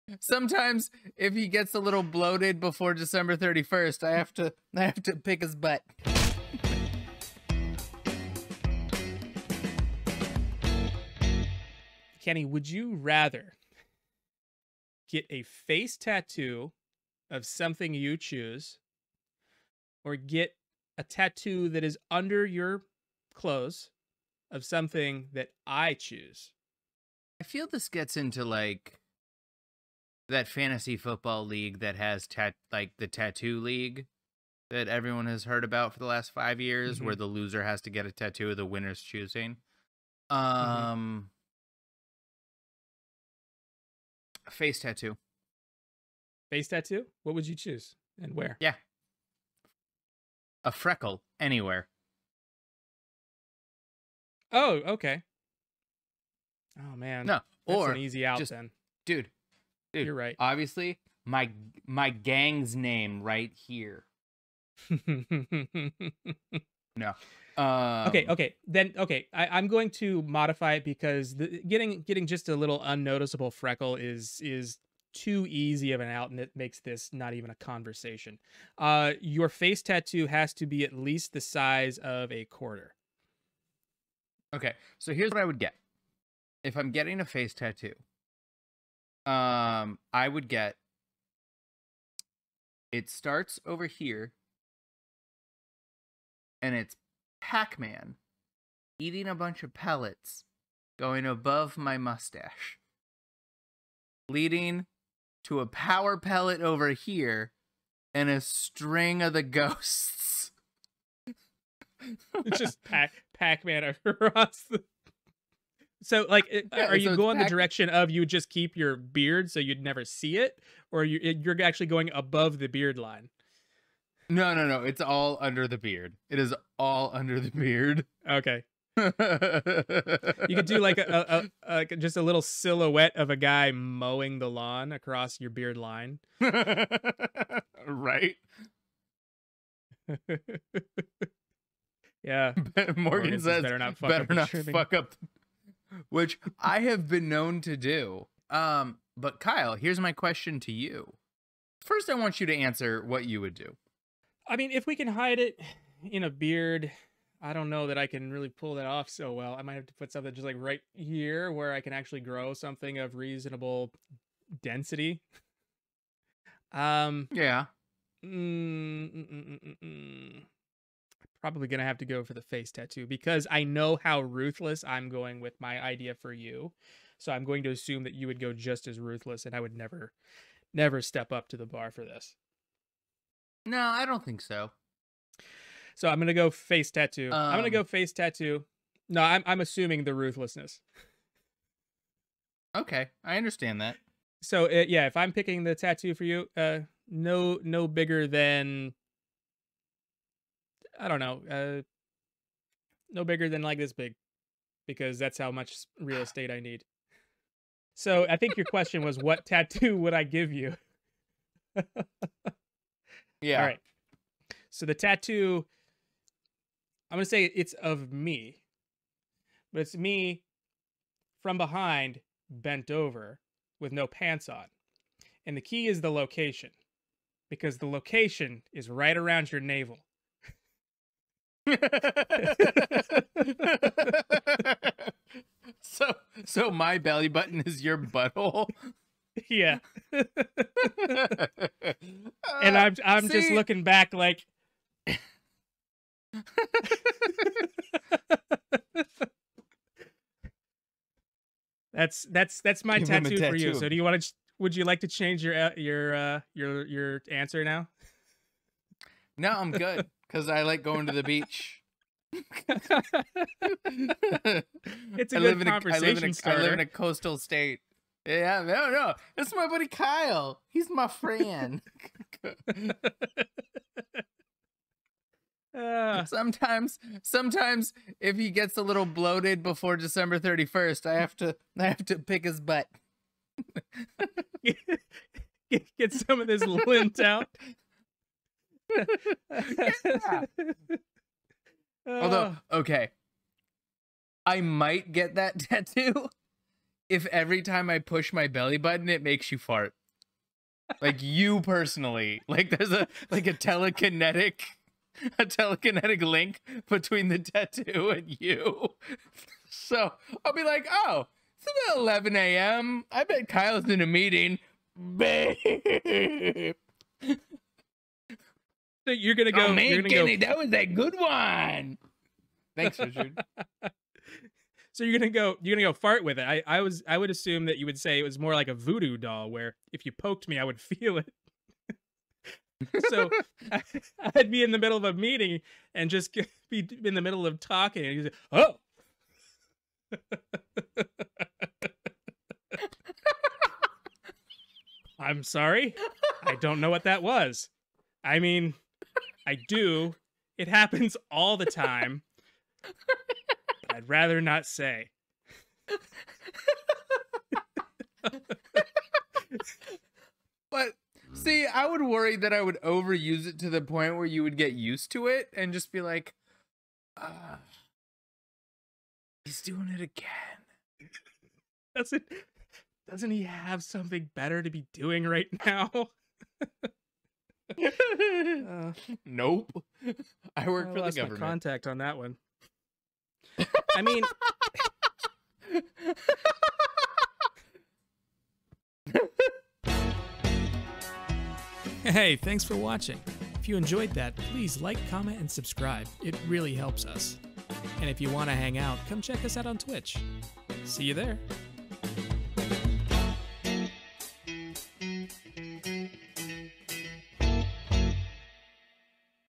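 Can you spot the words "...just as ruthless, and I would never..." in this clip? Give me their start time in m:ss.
2:58.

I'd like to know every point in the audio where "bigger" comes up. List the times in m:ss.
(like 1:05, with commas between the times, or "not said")
3:17, 3:23.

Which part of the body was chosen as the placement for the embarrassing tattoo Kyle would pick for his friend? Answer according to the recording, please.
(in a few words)
navel.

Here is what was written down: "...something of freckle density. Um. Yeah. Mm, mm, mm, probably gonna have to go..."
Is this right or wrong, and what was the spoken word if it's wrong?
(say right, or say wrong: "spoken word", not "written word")
wrong: "reasonable", not "freckle".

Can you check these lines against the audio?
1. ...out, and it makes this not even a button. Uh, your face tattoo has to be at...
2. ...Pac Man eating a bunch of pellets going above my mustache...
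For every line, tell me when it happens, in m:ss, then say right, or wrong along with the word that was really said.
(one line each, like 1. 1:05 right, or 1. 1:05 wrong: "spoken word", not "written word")
1. 1:16 wrong: "conversation", not "button"
2. 1:37 right.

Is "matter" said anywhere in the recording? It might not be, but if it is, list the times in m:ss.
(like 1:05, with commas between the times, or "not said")
not said.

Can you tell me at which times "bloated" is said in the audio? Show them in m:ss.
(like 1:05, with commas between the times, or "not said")
0:02, 4:39.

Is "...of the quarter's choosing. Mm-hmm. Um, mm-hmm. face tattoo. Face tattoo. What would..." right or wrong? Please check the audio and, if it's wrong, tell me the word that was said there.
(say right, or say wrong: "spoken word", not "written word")
wrong: "winner", not "quarter".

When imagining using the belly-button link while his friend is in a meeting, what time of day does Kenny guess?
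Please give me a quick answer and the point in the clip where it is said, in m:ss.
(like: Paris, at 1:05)
11 a.m., at 5:12.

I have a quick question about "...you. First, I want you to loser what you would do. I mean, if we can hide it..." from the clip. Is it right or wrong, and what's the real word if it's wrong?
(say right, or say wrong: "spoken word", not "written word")
wrong: "answer", not "loser".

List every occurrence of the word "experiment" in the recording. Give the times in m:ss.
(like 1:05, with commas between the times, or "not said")
not said.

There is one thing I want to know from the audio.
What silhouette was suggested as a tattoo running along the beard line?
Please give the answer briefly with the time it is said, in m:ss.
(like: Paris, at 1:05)
a guy mowing the lawn, at 2:13.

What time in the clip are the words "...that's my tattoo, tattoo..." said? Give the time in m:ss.
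4:12.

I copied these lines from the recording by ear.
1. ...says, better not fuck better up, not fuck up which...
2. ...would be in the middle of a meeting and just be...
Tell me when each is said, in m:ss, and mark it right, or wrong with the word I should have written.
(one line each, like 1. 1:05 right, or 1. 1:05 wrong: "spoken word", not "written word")
1. 2:23 right
2. 5:34 right.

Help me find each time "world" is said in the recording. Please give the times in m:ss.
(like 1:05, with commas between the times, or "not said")
not said.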